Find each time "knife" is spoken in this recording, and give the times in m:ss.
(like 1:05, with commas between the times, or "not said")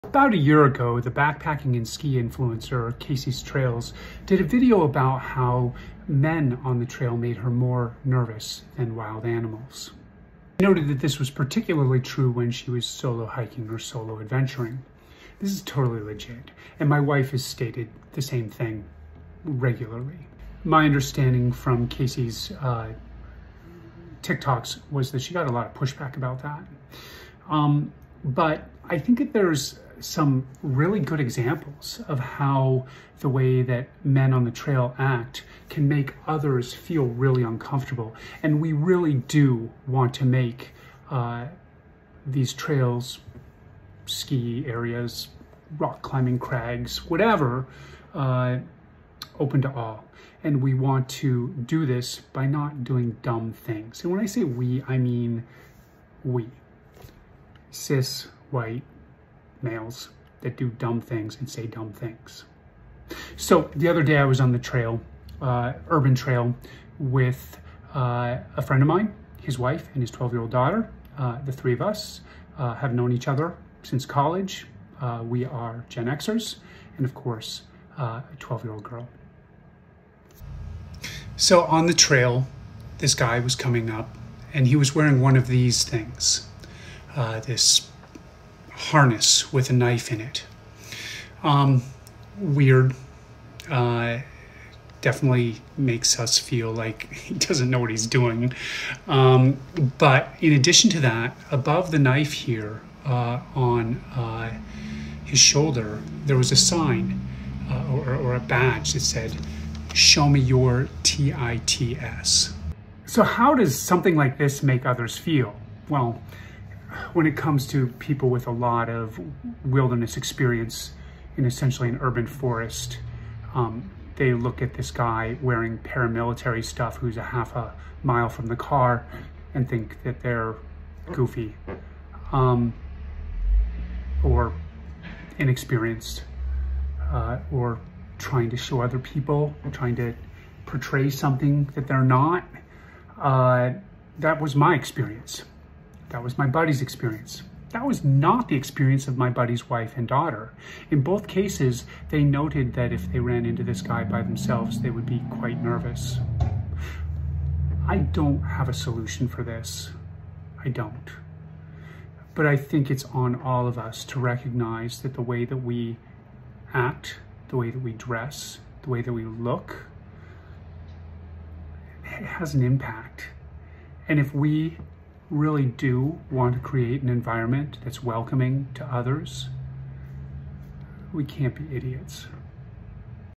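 1:29, 1:41.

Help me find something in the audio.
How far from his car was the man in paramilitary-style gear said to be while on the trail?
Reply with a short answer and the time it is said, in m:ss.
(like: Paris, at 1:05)
Half a mile, at 2:07.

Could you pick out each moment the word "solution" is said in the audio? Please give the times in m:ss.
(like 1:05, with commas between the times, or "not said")
2:38.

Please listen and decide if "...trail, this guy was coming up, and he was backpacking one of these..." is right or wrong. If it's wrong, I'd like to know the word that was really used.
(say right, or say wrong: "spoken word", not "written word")
wrong: "wearing", not "backpacking".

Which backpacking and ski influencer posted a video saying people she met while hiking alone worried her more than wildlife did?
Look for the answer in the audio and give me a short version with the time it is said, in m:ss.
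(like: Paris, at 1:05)
Casey's Trails, at 0:02.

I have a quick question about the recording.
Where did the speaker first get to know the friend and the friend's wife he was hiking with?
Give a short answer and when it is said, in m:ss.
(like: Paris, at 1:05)
College, at 1:14.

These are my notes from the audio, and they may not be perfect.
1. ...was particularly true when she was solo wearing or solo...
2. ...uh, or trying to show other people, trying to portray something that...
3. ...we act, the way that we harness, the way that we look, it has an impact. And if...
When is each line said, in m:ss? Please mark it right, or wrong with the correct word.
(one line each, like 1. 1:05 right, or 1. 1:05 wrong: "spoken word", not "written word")
1. 0:11 wrong: "hiking", not "wearing"
2. 2:17 right
3. 2:45 wrong: "dress", not "harness".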